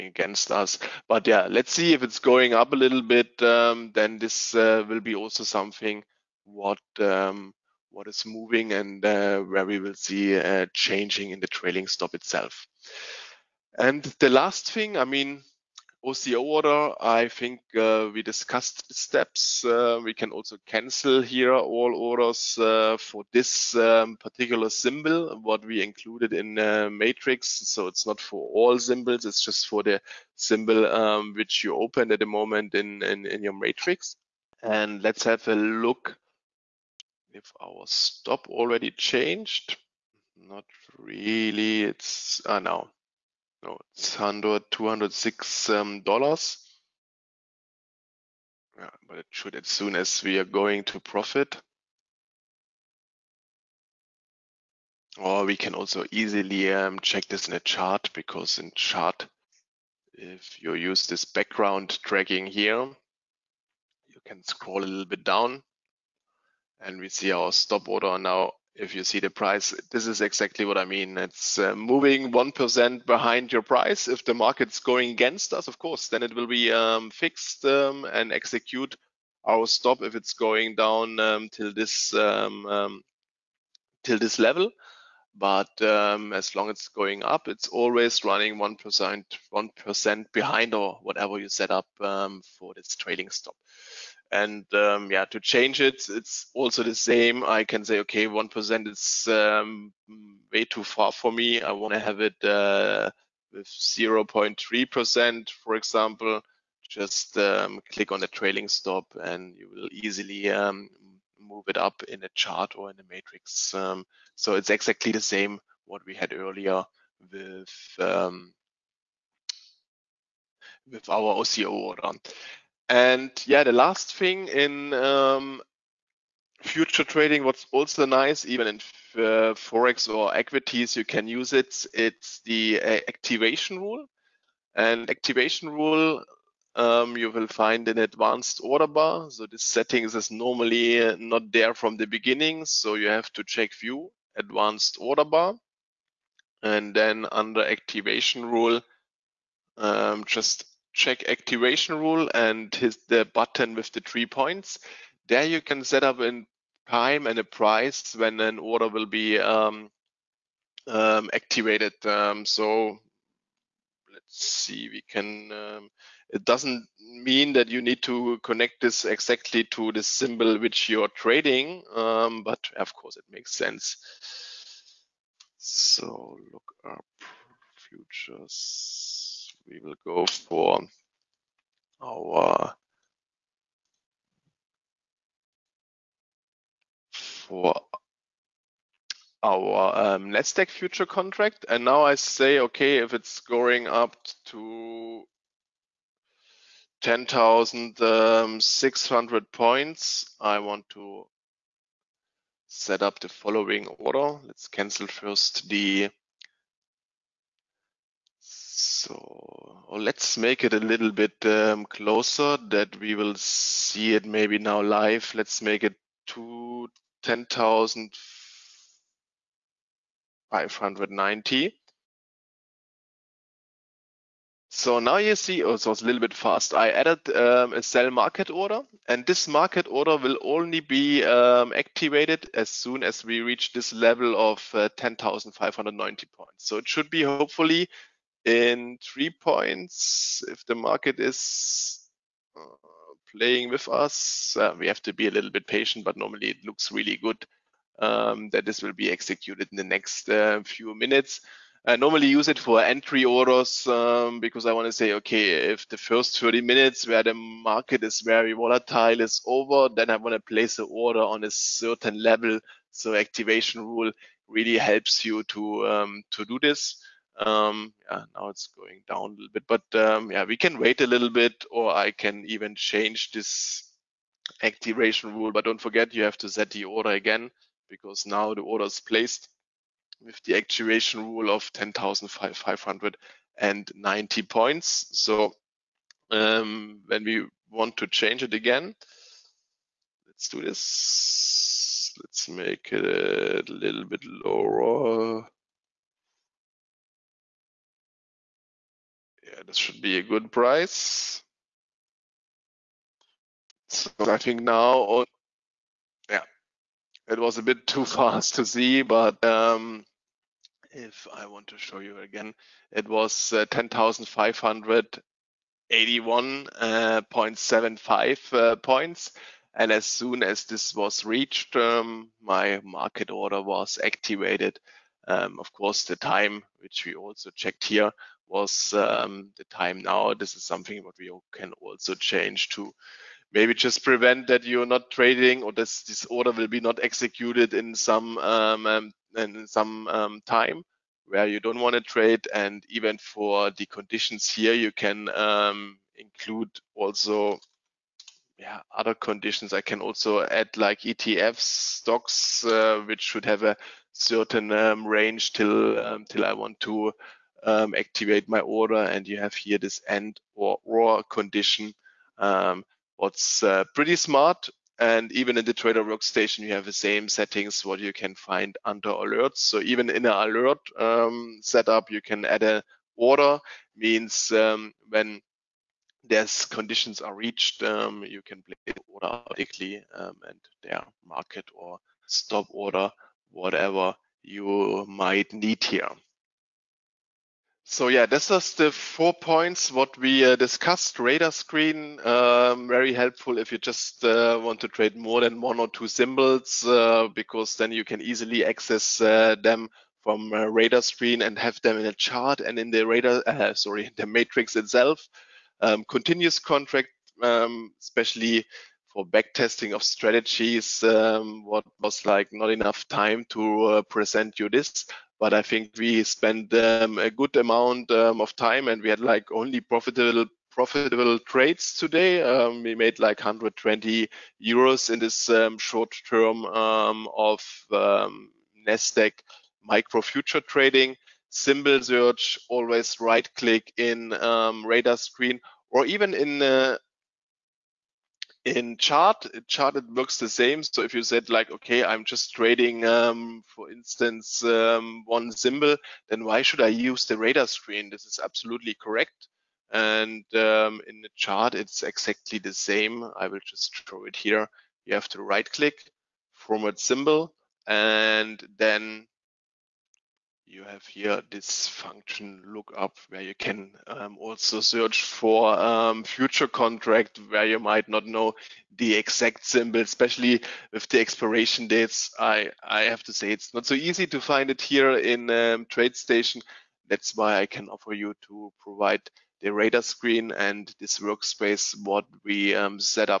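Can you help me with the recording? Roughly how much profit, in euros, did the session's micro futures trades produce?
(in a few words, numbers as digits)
120 euros.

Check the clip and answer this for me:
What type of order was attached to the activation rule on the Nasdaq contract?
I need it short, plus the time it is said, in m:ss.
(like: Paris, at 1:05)
sell market order, at 3:47.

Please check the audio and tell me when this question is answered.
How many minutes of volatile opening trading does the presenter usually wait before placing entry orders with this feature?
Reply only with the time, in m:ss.
4:16.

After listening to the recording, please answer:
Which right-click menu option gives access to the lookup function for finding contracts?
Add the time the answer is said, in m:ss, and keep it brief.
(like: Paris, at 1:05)
format symbol, at 7:36.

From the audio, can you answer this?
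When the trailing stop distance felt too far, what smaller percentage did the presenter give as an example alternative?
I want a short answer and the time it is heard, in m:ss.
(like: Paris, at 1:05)
0.3%, at 1:43.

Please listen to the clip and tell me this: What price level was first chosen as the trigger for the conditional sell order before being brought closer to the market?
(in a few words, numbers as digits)
10,600.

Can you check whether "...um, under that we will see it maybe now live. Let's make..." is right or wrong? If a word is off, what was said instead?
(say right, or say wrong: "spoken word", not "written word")
wrong: "closer", not "under".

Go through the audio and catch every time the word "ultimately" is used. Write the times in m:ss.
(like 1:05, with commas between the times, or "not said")
not said.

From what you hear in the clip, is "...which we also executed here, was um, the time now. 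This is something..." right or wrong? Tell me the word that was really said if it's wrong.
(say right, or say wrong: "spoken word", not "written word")
wrong: "checked", not "executed".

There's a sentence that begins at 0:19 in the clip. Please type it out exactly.
Uh, we can also cancel here all orders uh, for this um, particular symbol, what we included in uh, matrix.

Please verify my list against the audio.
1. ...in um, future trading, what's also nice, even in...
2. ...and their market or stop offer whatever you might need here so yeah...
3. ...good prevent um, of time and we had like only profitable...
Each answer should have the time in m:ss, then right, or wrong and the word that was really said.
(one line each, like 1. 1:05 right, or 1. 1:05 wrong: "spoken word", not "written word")
1. 2:04 right
2. 6:20 wrong: "order", not "offer"
3. 6:57 wrong: "amount", not "prevent".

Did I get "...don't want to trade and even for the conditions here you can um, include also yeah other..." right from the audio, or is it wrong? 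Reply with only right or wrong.
right.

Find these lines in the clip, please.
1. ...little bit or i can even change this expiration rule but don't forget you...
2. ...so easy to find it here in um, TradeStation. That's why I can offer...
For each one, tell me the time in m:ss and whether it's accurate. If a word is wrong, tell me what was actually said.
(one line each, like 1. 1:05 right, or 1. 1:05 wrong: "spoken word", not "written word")
1. 4:31 wrong: "activation", not "expiration"
2. 7:53 right.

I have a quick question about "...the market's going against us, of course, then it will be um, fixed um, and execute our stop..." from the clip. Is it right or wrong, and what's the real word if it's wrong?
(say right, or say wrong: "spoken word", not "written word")
right.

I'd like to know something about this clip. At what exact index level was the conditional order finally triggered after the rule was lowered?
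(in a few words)
10,581.75.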